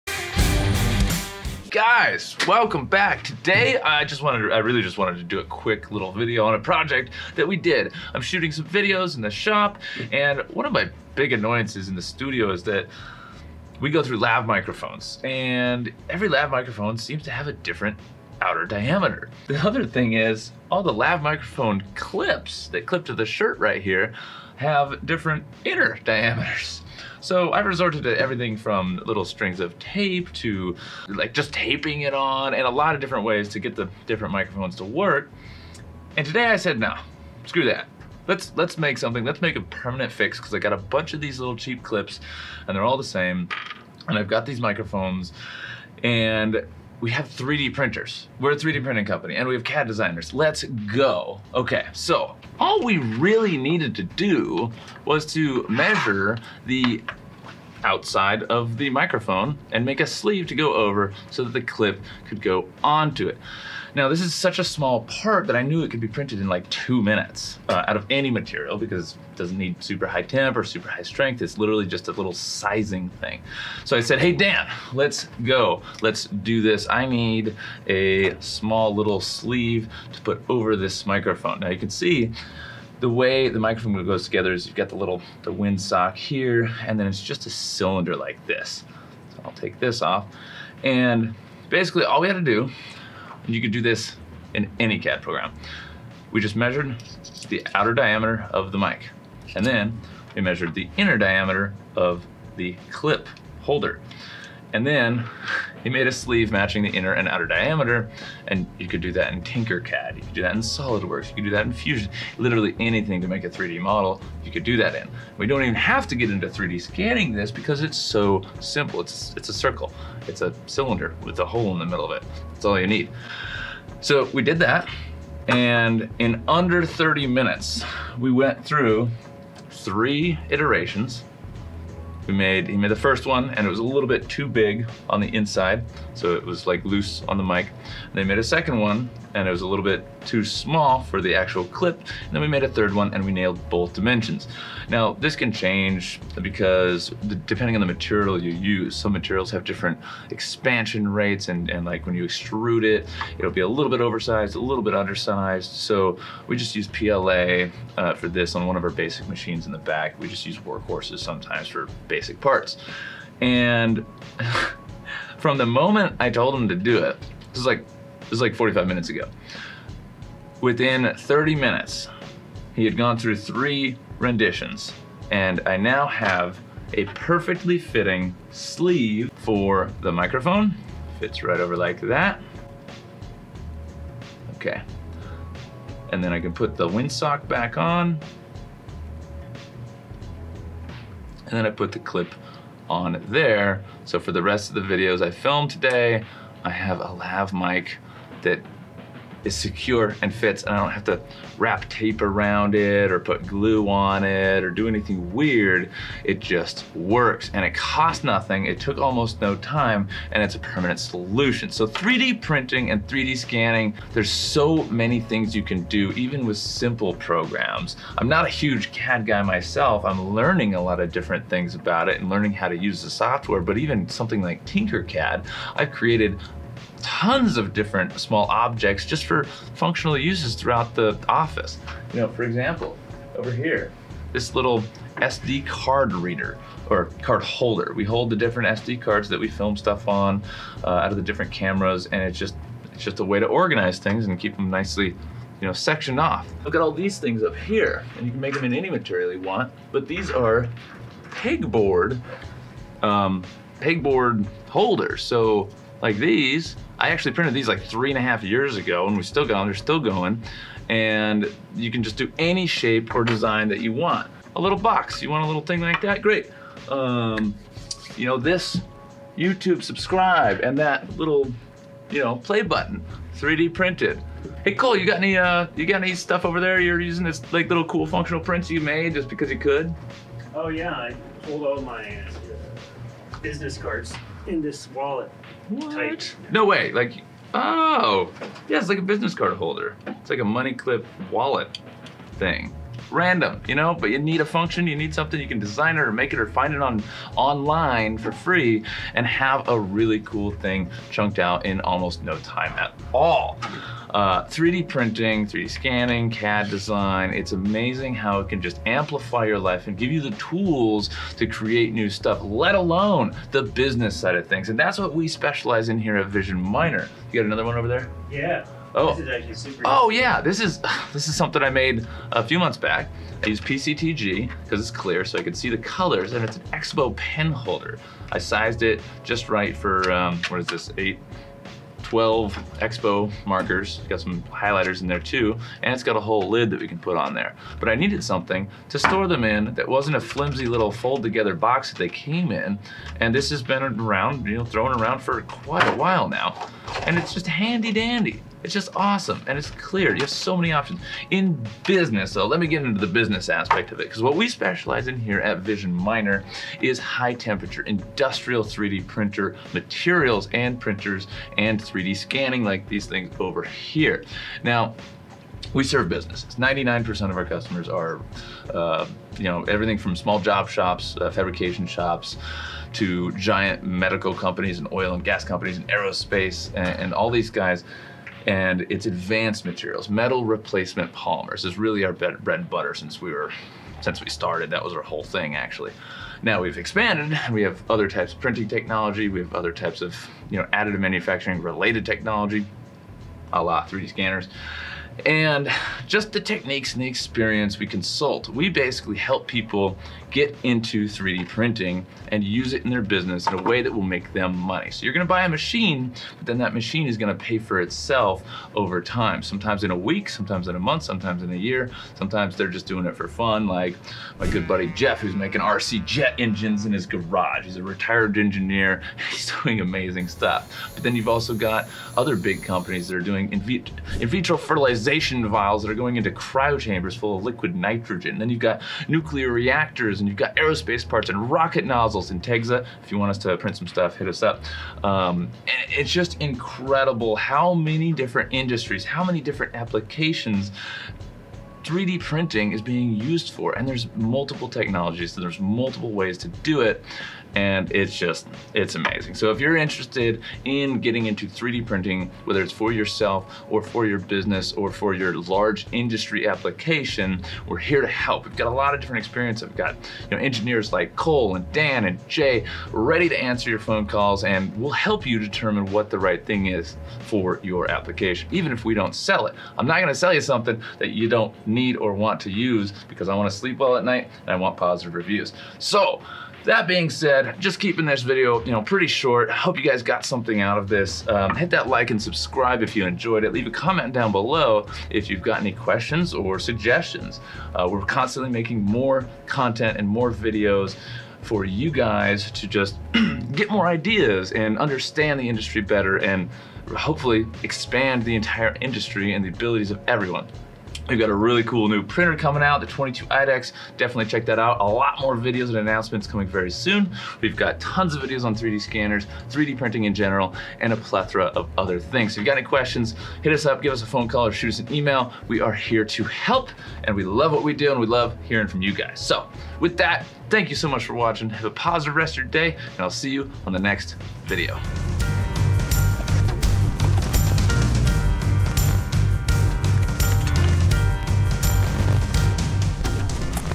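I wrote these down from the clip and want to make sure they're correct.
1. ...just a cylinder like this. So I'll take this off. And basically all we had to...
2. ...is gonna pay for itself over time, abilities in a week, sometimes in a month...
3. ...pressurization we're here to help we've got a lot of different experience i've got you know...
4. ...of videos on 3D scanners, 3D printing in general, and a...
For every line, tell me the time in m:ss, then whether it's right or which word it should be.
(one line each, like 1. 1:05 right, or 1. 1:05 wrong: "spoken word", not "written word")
1. 1:27 right
2. 6:47 wrong: "sometimes", not "abilities"
3. 7:36 wrong: "application", not "pressurization"
4. 8:28 right.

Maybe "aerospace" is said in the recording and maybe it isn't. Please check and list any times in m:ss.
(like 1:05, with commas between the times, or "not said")
6:15, 7:10.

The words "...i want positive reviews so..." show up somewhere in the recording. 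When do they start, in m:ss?
7:54.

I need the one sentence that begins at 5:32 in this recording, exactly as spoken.
12 Expo markers, got some highlighters in there too, and it's got a whole lid that we can put on there.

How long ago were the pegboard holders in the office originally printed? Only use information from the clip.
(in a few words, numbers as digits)
3.5 years ago.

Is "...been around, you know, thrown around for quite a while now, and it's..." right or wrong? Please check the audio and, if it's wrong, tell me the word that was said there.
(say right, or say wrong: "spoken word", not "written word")
right.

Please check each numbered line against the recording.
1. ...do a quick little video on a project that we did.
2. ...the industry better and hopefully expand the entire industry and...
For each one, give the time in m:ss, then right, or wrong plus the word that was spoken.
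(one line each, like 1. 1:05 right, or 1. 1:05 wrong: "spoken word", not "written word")
1. 0:05 right
2. 8:15 right.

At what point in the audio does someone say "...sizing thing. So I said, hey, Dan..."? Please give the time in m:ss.
1:12.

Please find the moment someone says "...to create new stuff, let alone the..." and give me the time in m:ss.
5:11.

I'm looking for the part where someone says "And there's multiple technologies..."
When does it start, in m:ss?
7:23.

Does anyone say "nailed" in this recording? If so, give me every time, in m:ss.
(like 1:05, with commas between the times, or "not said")
2:23.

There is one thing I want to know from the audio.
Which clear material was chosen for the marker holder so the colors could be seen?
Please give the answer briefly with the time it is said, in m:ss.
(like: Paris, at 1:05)
PCTG, at 5:23.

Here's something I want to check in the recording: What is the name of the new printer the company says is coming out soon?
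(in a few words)
22 IDEX.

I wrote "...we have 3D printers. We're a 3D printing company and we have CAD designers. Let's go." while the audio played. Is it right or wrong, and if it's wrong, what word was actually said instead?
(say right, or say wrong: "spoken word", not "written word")
right.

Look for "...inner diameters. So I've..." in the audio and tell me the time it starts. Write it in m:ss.
0:25.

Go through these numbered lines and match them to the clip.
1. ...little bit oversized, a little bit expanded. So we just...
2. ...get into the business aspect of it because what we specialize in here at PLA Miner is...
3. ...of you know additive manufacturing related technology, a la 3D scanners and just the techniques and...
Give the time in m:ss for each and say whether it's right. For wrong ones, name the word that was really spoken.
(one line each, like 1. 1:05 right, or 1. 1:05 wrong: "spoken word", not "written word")
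1. 2:33 wrong: "undersized", not "expanded"
2. 5:52 wrong: "Vision", not "PLA"
3. 6:30 right.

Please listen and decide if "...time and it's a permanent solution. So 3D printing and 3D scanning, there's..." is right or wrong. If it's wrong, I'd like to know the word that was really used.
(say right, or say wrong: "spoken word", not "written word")
right.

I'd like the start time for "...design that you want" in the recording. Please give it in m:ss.
4:23.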